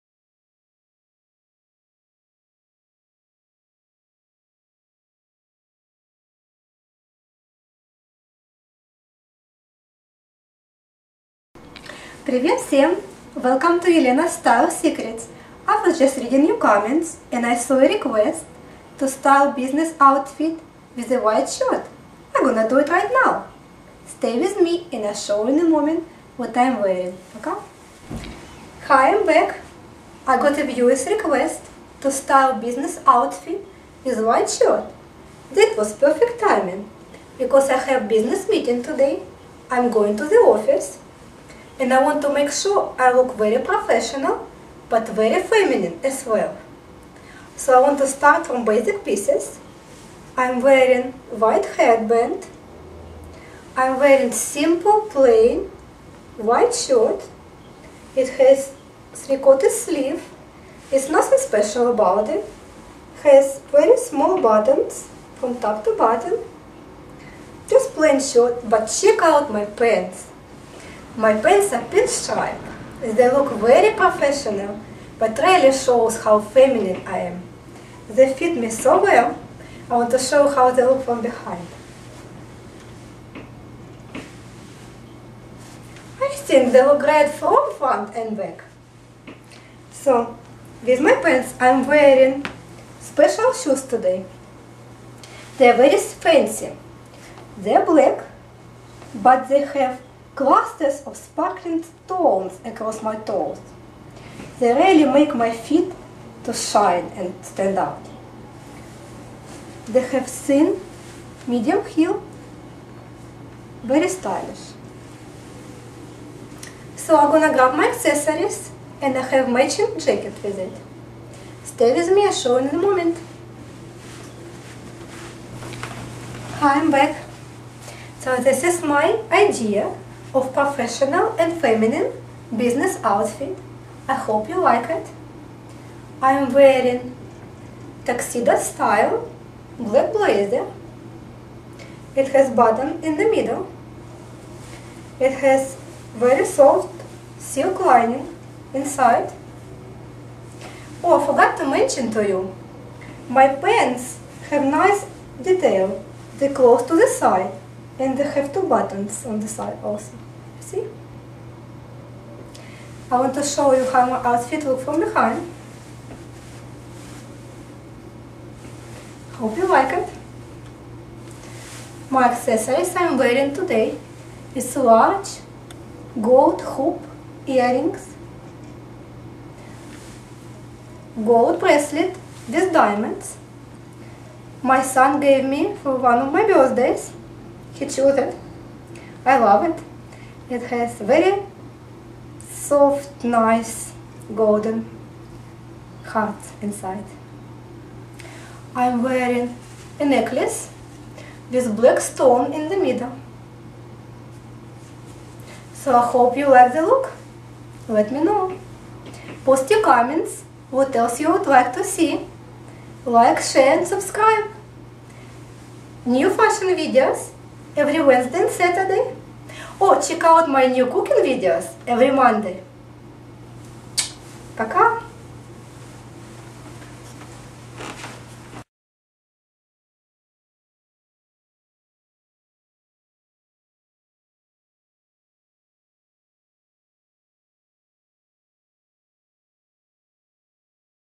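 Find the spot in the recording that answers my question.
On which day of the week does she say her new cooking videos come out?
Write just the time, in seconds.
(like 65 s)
222 s.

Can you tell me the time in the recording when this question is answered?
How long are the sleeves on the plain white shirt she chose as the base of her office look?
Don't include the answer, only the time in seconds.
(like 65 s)
59 s.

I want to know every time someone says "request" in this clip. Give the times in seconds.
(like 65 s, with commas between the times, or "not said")
17 s, 31 s.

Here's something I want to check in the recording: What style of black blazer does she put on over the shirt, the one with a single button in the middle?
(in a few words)
Tuxedo style.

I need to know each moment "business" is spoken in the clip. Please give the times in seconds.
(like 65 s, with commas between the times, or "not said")
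19 s, 32 s, 38 s, 132 s.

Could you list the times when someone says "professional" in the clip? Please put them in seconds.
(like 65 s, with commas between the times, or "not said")
43 s, 73 s, 130 s.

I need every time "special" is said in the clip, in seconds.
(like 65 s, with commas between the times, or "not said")
61 s, 93 s.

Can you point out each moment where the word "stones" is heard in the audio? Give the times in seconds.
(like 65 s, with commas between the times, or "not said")
101 s, 201 s.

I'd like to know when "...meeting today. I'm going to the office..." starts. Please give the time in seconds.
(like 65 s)
38 s.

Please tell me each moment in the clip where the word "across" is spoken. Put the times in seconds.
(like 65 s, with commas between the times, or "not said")
102 s.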